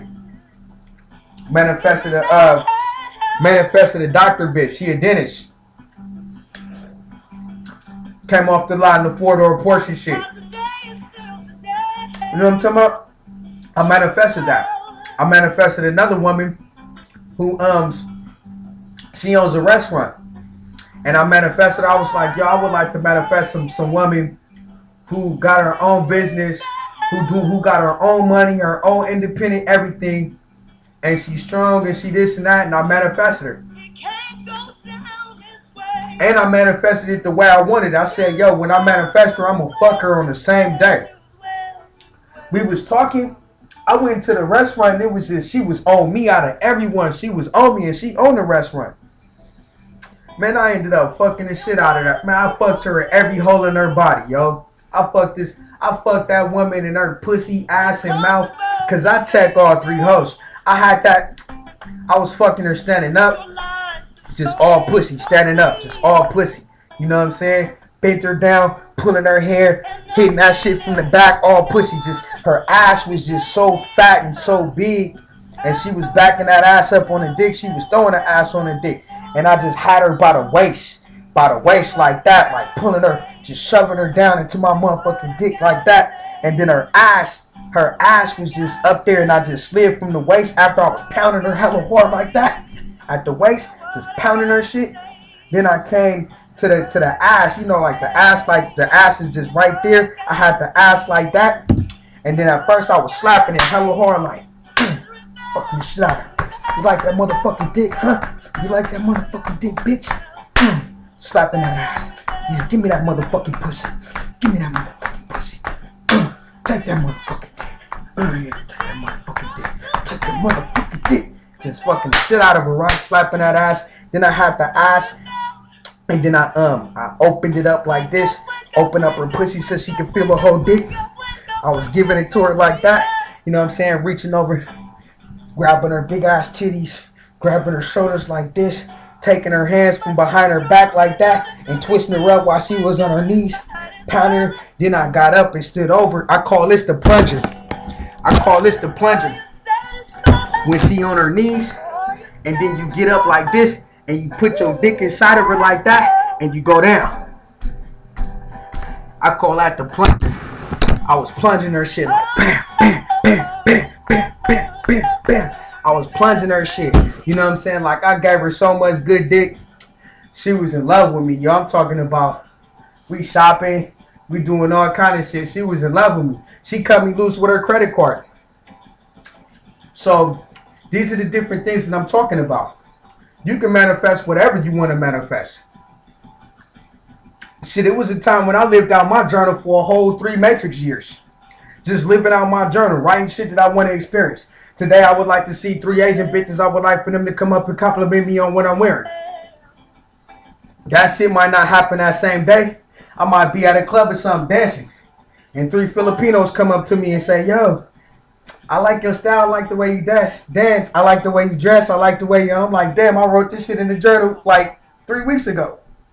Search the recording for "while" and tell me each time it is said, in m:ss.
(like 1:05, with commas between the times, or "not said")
2:22.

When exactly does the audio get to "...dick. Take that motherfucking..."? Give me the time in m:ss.
1:59.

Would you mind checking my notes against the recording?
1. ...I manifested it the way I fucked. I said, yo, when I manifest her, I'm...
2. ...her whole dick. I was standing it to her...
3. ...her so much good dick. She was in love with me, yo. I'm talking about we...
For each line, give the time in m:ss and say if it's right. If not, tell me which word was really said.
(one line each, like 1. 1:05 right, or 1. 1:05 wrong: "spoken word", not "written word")
1. 0:36 wrong: "wanted", not "fucked"
2. 2:10 wrong: "giving", not "standing"
3. 2:48 right.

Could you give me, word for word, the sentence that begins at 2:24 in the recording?
Then I got up and stood over.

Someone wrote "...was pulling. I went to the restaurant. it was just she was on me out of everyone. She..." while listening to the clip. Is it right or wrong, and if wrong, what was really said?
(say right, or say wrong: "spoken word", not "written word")
wrong: "talking", not "pulling".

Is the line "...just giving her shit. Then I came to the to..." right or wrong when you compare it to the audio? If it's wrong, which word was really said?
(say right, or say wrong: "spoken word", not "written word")
wrong: "pounding", not "giving".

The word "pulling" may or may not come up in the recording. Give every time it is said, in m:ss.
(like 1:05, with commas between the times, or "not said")
1:08, 1:22.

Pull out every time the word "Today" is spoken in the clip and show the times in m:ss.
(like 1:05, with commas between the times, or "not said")
3:14.